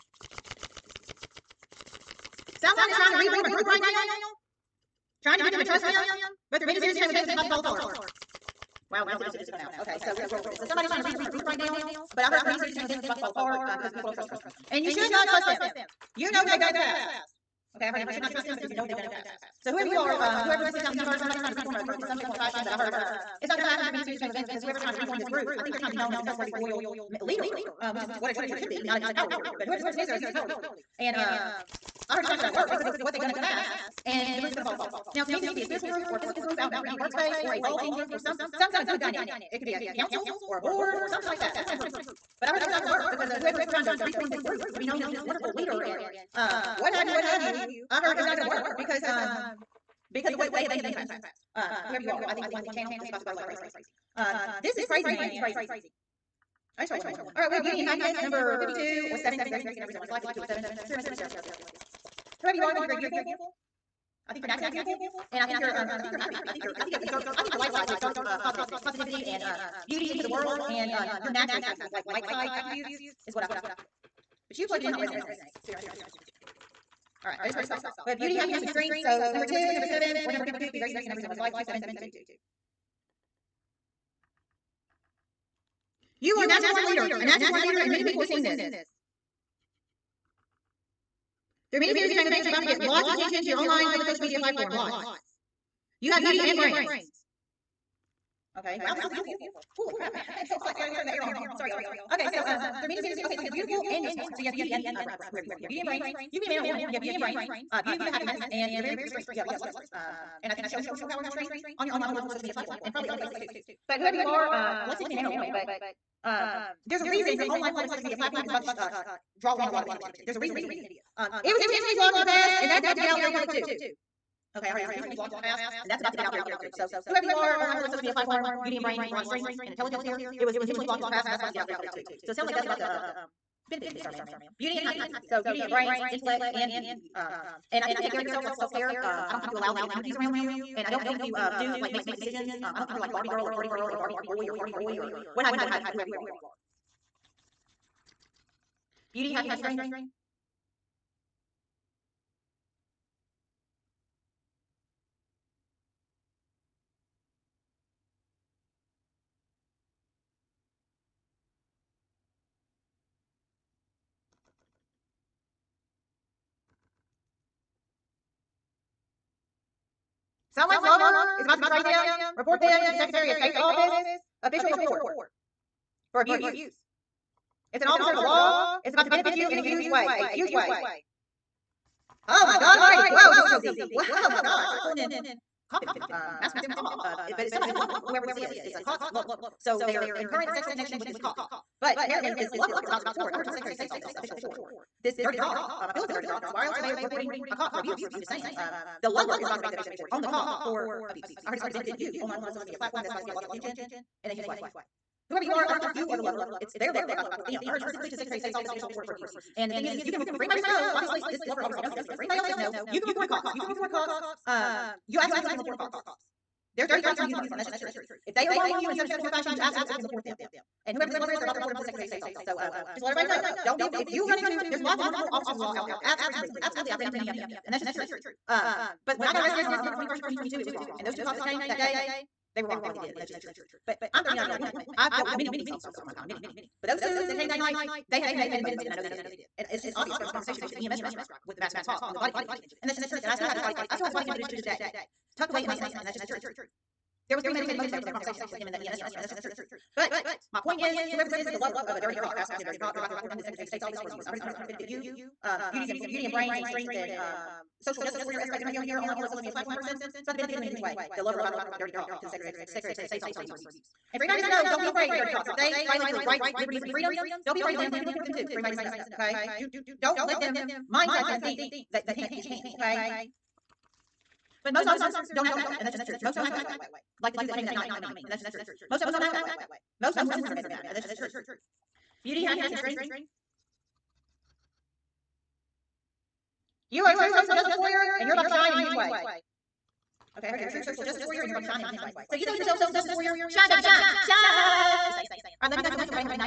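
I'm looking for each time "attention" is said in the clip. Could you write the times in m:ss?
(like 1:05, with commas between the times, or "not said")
1:33, 1:59, 3:23.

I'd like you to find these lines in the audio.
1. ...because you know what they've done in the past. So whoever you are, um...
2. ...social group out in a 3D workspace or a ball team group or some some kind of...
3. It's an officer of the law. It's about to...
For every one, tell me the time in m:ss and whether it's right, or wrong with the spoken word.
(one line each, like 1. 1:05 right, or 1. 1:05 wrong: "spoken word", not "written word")
1. 0:18 right
2. 0:36 wrong: "physical", not "social"
3. 2:57 right.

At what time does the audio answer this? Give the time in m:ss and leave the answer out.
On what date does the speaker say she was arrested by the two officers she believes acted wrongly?
3:49.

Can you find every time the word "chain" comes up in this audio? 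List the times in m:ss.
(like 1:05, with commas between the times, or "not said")
0:06, 0:12, 0:24.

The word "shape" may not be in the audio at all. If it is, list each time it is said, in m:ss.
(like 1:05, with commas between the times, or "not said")
0:22, 3:39.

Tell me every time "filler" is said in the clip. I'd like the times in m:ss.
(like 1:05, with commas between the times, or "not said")
not said.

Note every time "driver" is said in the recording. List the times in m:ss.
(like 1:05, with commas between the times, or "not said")
4:01, 4:08.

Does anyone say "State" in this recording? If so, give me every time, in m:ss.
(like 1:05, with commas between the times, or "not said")
2:53, 3:13, 3:28, 3:42, 4:13, 4:23.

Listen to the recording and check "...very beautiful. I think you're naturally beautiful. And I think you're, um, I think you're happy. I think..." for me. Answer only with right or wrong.
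right.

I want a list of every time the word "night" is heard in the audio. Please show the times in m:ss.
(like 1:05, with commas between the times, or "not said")
3:57, 4:37.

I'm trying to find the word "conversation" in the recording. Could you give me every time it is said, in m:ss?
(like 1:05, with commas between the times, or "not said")
4:00, 4:08.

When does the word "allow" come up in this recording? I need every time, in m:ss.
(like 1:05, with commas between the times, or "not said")
2:19.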